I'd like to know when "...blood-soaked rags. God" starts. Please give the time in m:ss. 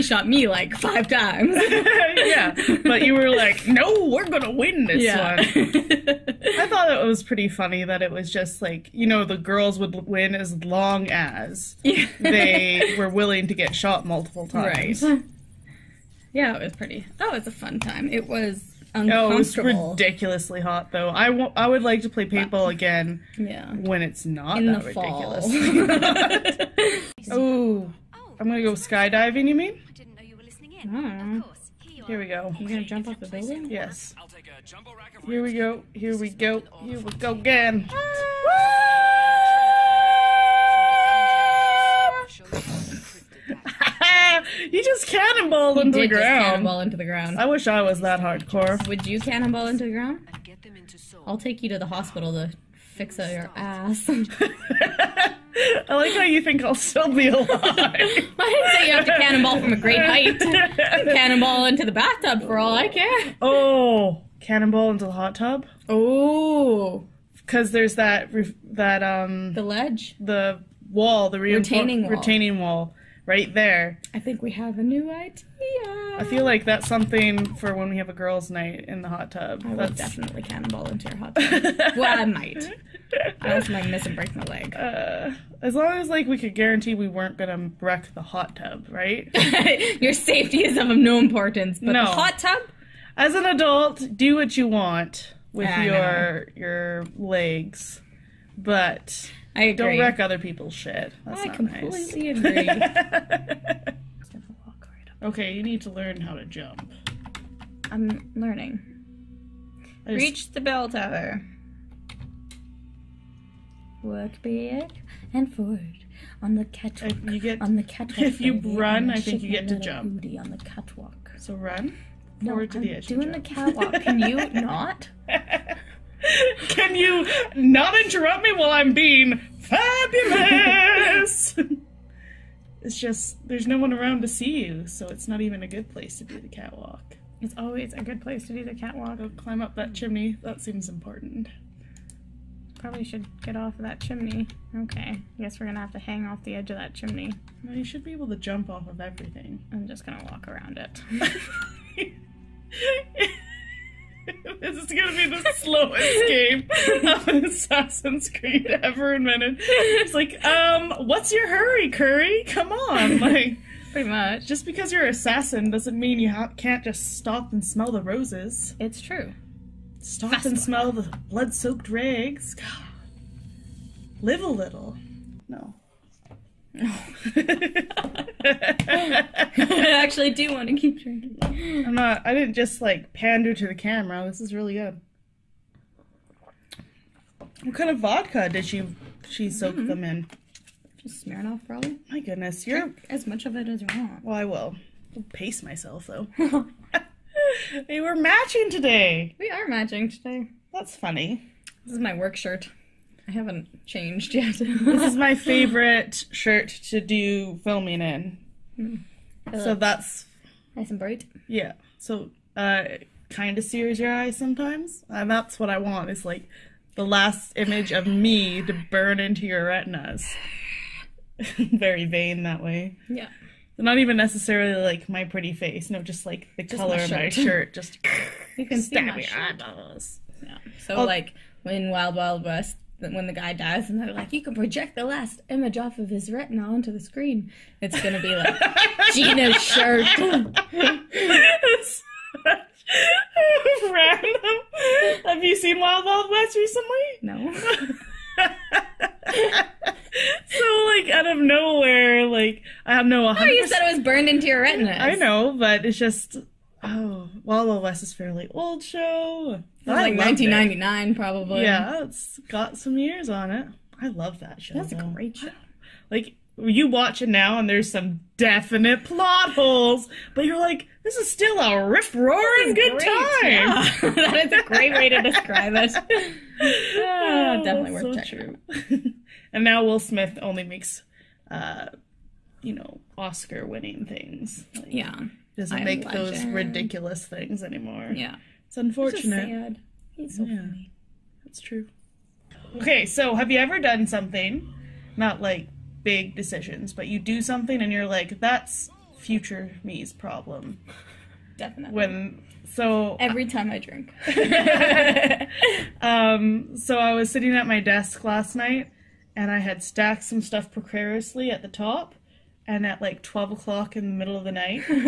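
2:51.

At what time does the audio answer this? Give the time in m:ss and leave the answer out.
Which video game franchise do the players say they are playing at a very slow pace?
2:37.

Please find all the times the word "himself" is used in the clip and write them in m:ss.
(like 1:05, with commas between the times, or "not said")
not said.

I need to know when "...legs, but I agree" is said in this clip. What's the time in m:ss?
1:37.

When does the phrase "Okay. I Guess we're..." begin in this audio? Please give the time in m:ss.
2:24.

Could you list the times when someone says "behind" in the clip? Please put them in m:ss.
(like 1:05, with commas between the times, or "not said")
not said.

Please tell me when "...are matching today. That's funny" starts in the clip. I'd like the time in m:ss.
3:19.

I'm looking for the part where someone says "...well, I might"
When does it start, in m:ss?
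1:21.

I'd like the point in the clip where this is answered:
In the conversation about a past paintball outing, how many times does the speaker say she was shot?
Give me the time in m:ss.
0:00.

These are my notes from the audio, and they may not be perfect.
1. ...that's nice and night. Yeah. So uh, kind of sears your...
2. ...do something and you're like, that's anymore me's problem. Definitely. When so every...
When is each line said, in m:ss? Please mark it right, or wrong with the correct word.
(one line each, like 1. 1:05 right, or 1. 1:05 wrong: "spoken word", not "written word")
1. 3:29 wrong: "bright", not "night"
2. 4:57 wrong: "future", not "anymore".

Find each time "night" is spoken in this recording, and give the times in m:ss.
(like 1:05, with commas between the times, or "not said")
1:18, 5:08, 5:14.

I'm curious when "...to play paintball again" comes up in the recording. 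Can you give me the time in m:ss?
0:22.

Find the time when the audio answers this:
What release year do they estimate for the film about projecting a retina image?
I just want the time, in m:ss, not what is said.
4:20.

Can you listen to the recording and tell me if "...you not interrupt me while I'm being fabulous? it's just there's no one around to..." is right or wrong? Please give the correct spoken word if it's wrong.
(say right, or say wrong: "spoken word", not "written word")
right.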